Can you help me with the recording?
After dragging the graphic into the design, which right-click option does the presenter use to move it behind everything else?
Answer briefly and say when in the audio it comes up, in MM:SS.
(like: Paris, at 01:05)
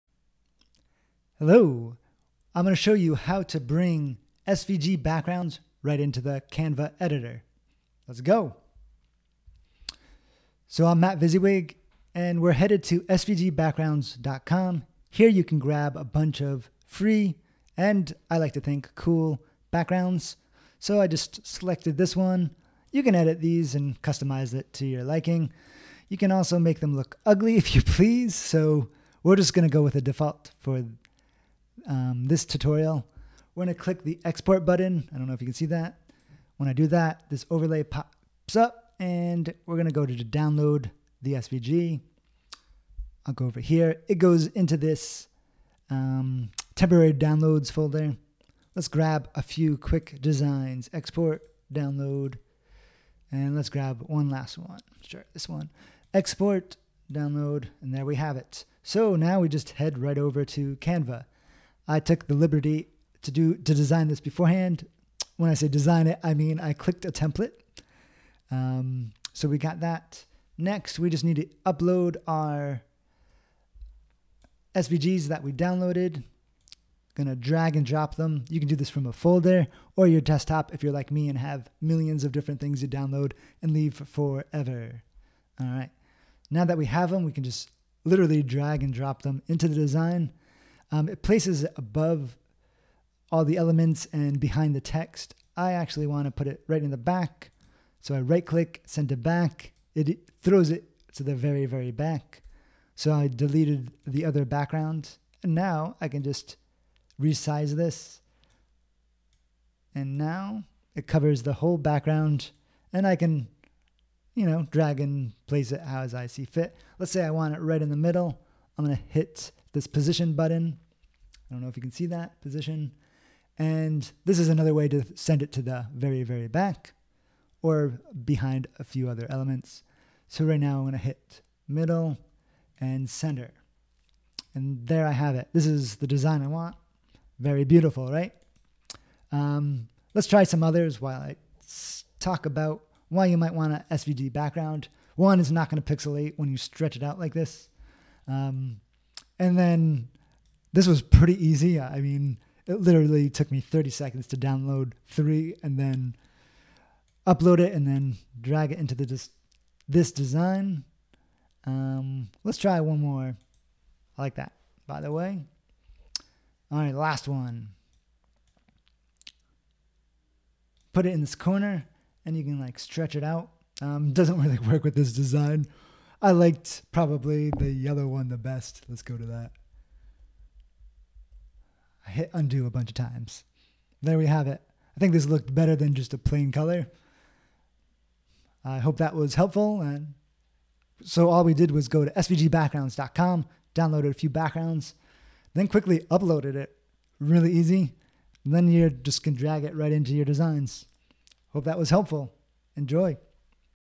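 send it back, at 01:38.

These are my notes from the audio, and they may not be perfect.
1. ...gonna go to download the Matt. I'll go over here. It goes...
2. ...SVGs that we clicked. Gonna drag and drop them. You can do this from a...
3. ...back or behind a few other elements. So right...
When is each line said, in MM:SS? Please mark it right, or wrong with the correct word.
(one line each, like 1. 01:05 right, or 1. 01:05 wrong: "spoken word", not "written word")
1. 00:39 wrong: "SVG", not "Matt"
2. 01:14 wrong: "downloaded", not "clicked"
3. 02:06 right.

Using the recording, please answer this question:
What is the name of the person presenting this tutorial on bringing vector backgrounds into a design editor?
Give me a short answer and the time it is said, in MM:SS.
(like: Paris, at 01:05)
Matt Visiwig, at 00:10.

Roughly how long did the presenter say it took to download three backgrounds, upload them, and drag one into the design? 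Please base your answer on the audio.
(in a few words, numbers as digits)
30 seconds.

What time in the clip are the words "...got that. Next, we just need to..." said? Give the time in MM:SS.
01:09.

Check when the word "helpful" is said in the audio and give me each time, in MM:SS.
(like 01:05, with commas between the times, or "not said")
03:09, 03:21.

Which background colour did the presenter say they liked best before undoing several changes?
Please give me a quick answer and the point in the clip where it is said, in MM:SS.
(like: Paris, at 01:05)
yellow, at 02:57.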